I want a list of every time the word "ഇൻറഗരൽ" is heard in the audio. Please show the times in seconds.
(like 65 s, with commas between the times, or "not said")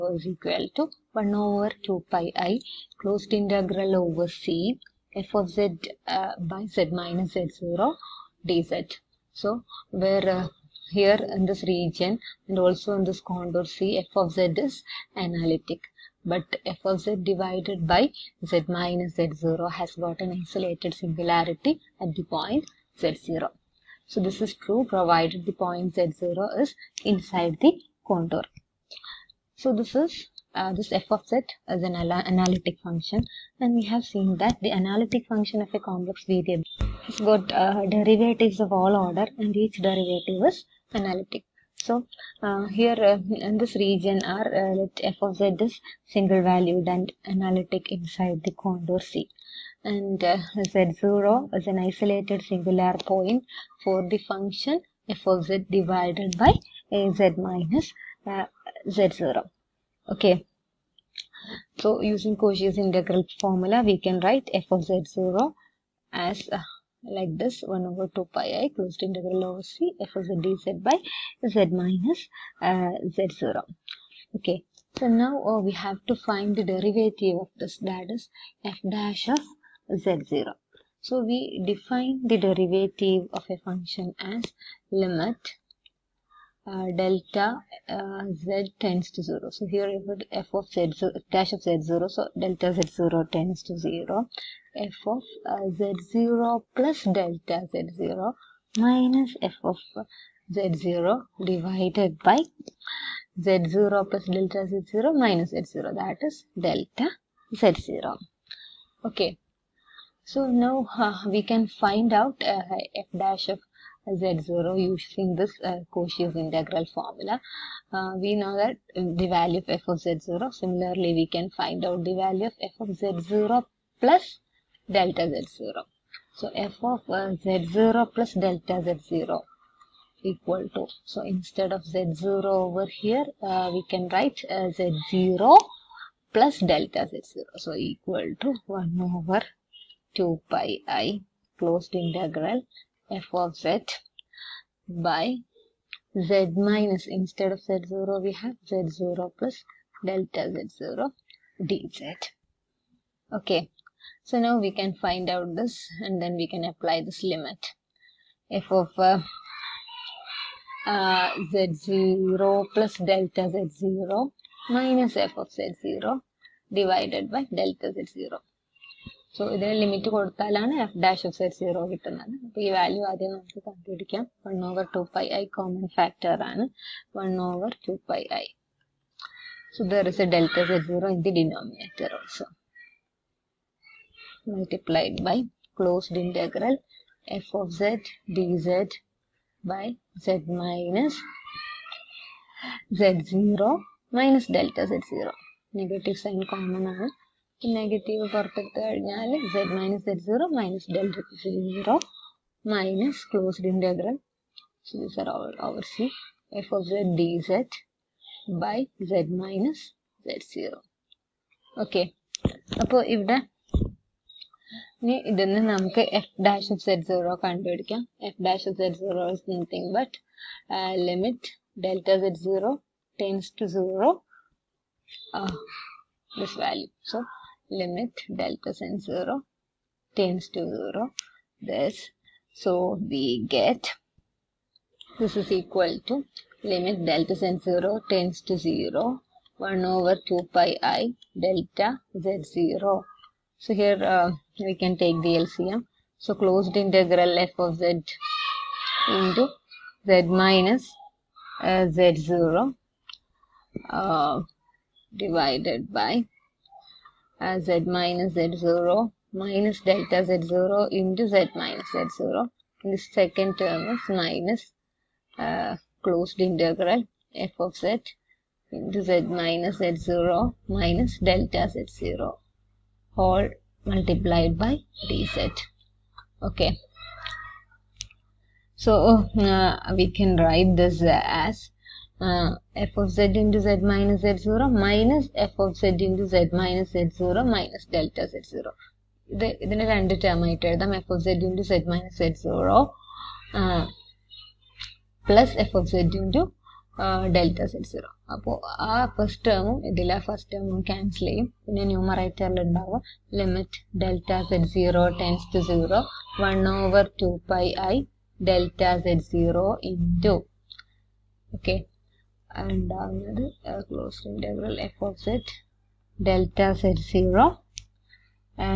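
203 s, 314 s.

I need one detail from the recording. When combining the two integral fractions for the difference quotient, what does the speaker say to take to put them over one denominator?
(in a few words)
The LCM.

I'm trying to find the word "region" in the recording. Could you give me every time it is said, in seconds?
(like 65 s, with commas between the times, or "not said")
11 s, 43 s.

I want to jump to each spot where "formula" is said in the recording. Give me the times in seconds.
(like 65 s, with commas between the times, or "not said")
63 s, 116 s.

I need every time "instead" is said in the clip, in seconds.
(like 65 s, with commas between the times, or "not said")
131 s, 147 s.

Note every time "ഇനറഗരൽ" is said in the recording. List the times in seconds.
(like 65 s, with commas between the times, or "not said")
186 s.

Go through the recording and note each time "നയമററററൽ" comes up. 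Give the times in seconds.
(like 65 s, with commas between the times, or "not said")
301 s.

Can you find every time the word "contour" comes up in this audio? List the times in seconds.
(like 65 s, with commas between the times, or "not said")
13 s, 28 s, 48 s.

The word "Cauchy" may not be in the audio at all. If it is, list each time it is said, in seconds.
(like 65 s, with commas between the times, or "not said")
62 s, 115 s.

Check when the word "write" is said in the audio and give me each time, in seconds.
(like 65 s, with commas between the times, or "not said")
64 s, 134 s, 280 s.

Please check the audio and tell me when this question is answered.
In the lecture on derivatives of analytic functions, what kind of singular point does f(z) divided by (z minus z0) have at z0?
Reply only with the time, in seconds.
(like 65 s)
20 s.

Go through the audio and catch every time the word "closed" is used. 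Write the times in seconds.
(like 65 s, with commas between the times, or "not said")
3 s, 68 s, 141 s, 246 s, 266 s.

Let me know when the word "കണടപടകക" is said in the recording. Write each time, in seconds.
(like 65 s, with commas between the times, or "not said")
173 s, 217 s.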